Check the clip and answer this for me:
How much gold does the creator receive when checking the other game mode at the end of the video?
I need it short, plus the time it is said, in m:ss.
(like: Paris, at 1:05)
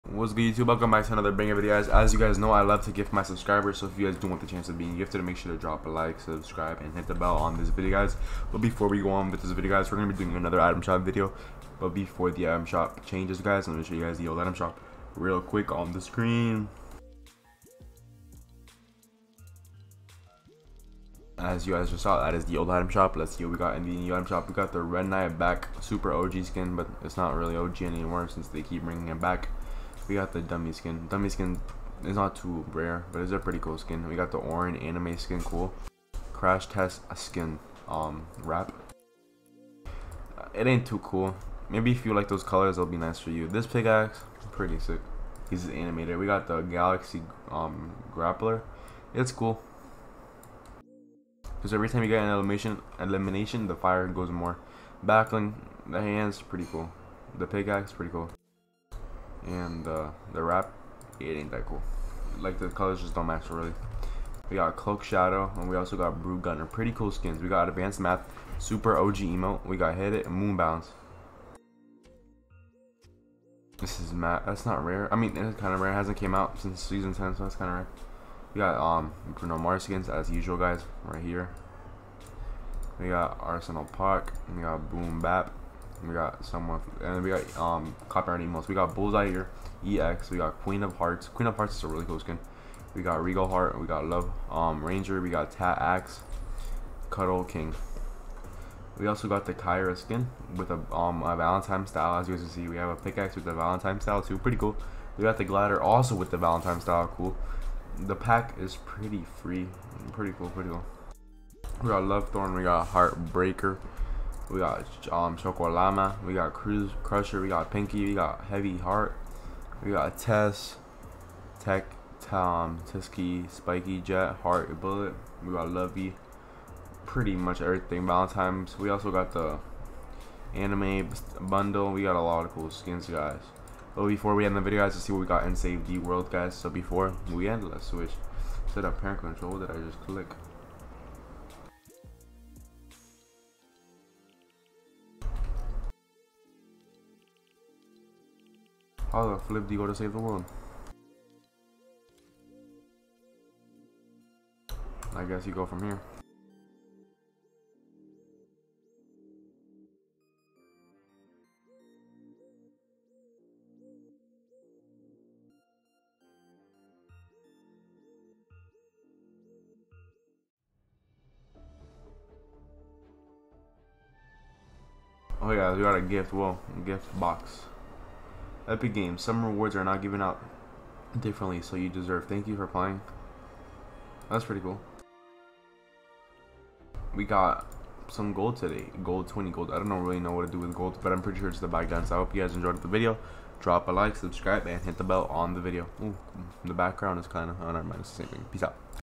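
20 gold, at 3:09.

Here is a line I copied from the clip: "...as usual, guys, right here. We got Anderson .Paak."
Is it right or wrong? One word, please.
right.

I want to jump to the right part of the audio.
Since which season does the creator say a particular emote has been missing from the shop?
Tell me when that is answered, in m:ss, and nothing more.
1:16.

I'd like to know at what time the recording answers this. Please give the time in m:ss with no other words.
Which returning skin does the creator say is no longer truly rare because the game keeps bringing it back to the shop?
0:24.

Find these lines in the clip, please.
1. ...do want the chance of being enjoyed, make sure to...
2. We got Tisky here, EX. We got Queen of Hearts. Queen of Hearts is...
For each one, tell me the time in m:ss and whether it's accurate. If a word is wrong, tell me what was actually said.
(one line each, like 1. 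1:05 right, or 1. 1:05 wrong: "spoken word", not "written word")
1. 0:04 wrong: "gifted", not "enjoyed"
2. 1:28 wrong: "Bullseye", not "Tisky".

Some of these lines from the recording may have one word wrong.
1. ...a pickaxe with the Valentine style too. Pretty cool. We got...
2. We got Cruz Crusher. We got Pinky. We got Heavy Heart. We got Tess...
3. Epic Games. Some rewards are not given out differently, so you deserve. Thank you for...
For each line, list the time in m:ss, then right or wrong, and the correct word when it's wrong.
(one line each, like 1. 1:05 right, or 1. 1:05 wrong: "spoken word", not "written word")
1. 1:42 right
2. 1:56 right
3. 2:58 right.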